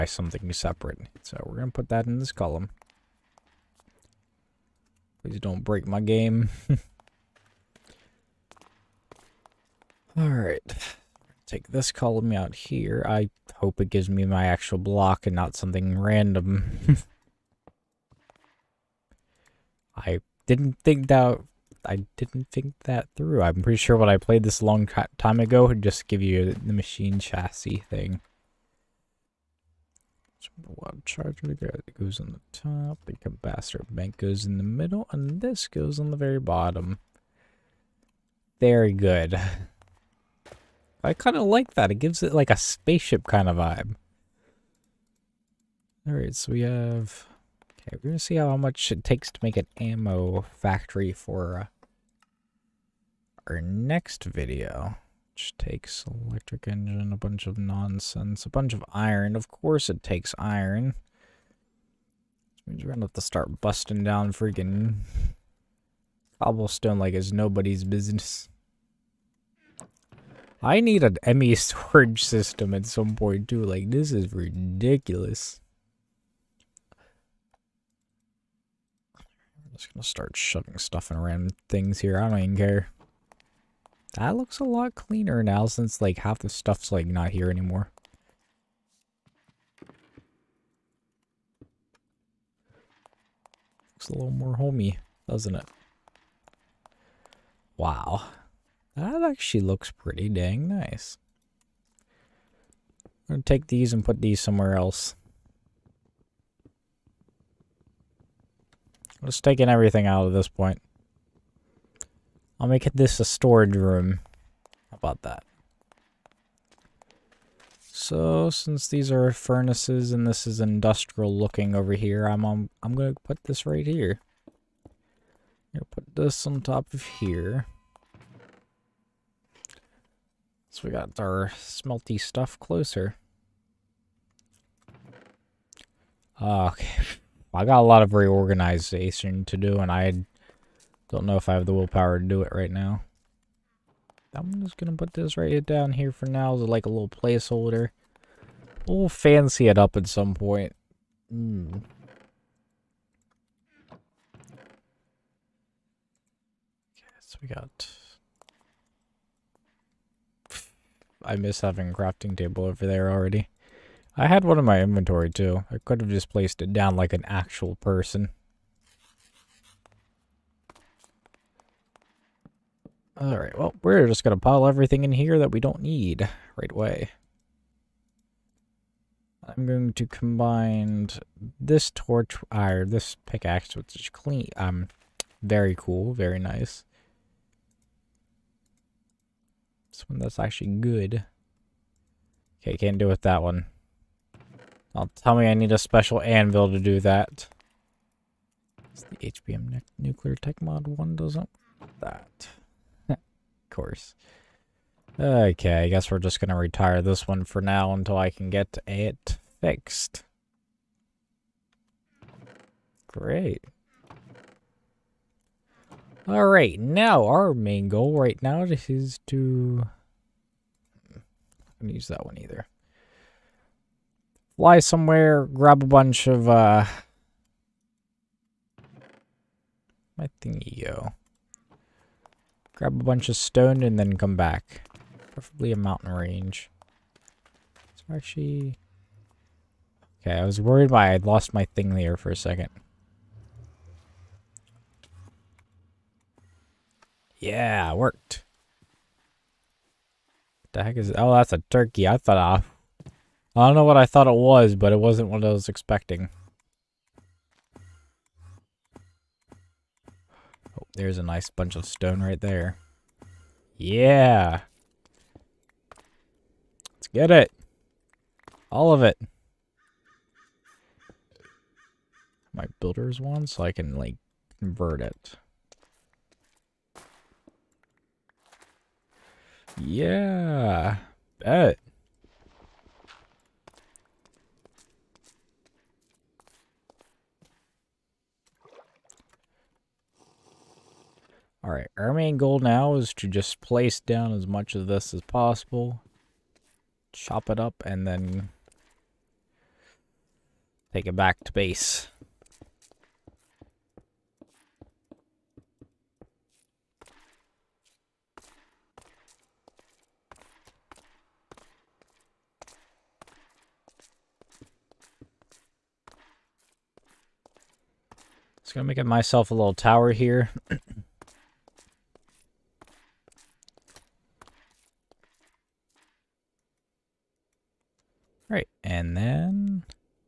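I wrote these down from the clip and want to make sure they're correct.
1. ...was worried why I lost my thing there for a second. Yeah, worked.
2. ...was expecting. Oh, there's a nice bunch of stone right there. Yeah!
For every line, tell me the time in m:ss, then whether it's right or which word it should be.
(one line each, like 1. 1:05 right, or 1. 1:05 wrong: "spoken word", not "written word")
1. 4:00 right
2. 4:15 right.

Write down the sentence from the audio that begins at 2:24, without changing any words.
I'm just going to put this right down here for now as like a little placeholder.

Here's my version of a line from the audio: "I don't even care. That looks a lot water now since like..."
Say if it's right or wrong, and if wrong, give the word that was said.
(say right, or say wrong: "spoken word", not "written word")
wrong: "cleaner", not "water".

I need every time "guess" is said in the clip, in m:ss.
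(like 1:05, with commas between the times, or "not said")
3:25.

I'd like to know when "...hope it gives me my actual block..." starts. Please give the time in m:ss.
0:13.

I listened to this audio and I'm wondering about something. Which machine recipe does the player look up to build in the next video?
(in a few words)
ammo factory.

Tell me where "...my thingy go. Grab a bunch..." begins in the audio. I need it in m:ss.
3:50.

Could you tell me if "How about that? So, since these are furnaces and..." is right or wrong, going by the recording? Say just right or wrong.
right.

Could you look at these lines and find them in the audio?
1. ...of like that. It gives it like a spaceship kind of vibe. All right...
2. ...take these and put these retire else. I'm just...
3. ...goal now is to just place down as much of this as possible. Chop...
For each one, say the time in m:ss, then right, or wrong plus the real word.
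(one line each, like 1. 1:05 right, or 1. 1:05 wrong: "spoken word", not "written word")
1. 0:41 right
2. 1:43 wrong: "somewhere", not "retire"
3. 4:52 right.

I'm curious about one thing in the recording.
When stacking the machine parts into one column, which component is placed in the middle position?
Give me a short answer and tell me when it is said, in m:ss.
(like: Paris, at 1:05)
capacitor bank, at 0:33.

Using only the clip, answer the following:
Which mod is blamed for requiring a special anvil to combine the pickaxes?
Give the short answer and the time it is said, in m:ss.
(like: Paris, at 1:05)
HBM Nuclear Tech Mod, at 3:19.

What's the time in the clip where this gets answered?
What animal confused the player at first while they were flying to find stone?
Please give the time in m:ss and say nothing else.
4:11.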